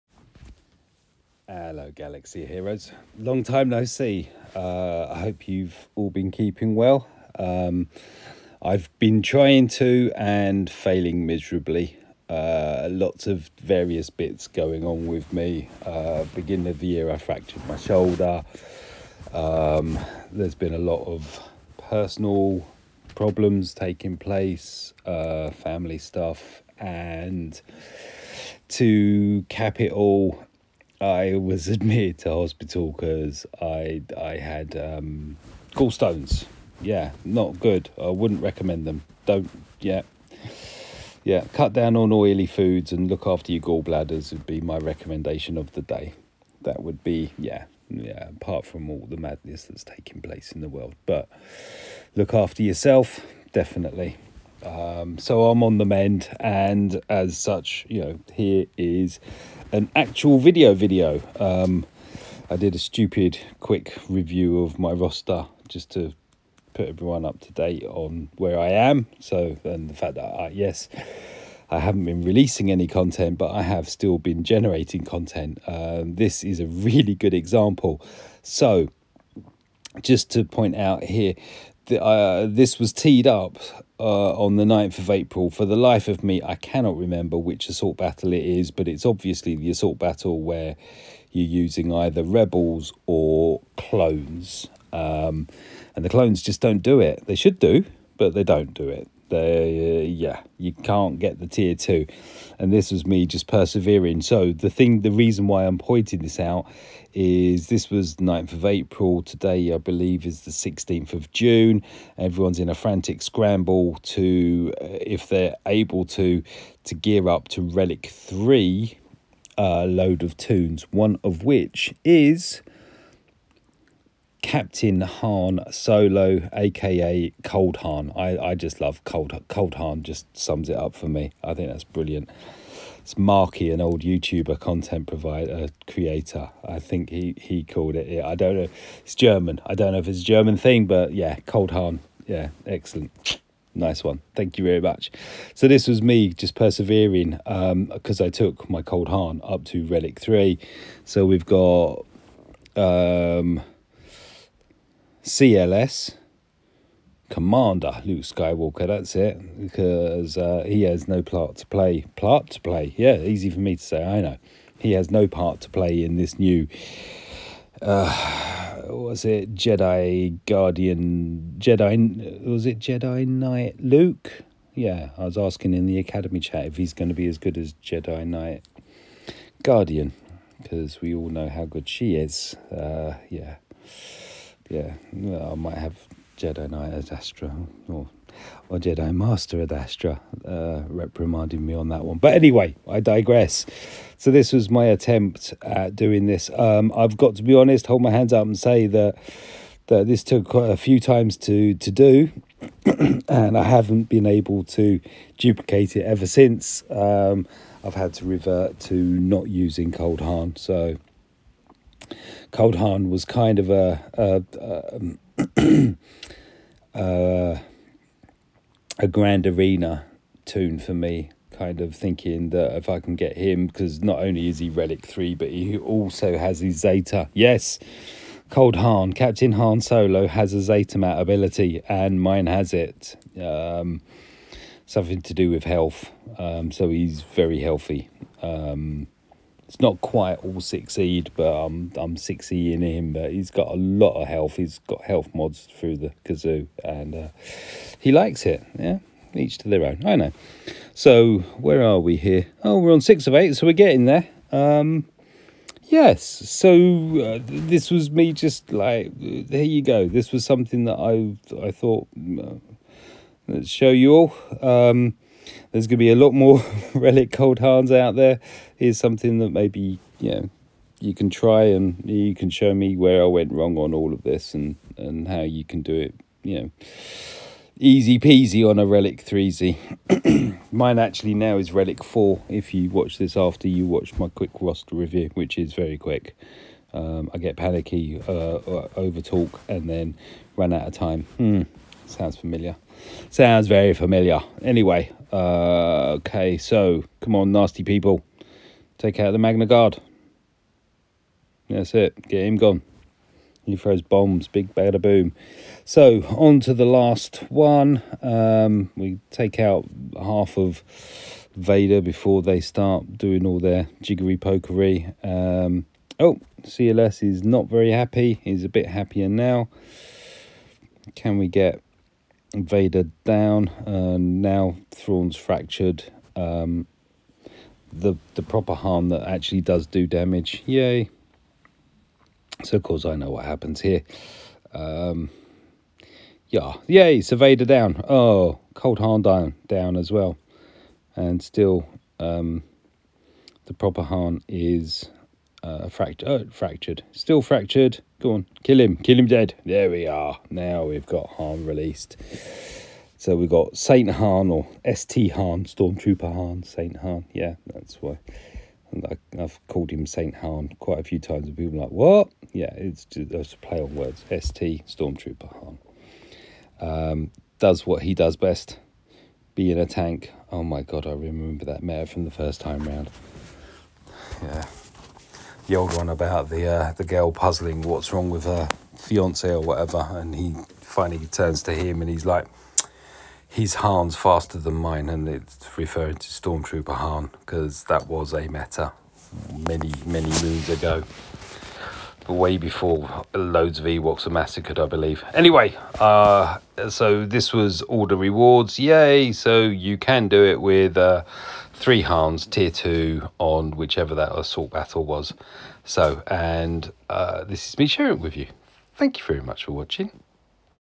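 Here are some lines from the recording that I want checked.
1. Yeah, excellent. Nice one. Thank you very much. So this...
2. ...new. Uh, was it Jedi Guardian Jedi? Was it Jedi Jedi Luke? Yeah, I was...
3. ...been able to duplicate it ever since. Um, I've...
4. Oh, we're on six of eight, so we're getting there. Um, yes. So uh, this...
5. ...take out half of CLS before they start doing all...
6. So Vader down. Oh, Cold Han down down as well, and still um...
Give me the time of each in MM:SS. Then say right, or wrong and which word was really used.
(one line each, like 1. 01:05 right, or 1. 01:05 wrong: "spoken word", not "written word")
1. 02:22 right
2. 02:46 wrong: "Knight", not "Jedi"
3. 03:24 right
4. 04:12 right
5. 05:09 wrong: "Vader", not "CLS"
6. 05:37 right.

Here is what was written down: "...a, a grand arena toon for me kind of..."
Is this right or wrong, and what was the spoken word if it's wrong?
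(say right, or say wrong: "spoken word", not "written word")
right.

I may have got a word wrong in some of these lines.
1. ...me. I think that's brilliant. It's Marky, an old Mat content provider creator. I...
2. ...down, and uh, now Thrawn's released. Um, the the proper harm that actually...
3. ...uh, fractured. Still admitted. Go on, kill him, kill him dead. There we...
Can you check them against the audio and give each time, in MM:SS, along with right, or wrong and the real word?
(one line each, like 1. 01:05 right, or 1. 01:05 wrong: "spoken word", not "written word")
1. 02:11 wrong: "YouTuber", not "Mat"
2. 05:23 wrong: "fractured", not "released"
3. 05:46 wrong: "fractured", not "admitted".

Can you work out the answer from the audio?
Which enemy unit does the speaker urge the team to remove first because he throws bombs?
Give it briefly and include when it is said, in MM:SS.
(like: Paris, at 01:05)
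Magna Guard, at 04:59.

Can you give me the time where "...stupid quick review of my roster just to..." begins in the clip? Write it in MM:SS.
01:02.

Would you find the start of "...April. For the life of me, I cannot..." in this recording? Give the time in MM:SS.
01:25.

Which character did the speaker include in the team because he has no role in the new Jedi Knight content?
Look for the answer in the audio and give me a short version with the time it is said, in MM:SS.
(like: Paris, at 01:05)
Commander Luke Skywalker, at 02:35.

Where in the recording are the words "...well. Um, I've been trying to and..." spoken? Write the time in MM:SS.
00:06.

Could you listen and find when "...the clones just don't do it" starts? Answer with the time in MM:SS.
01:36.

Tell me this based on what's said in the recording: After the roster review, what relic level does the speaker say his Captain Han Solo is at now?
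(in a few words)
Relic 4.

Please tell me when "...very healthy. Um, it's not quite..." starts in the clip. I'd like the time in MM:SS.
03:57.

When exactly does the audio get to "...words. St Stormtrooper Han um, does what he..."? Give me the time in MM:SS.
06:03.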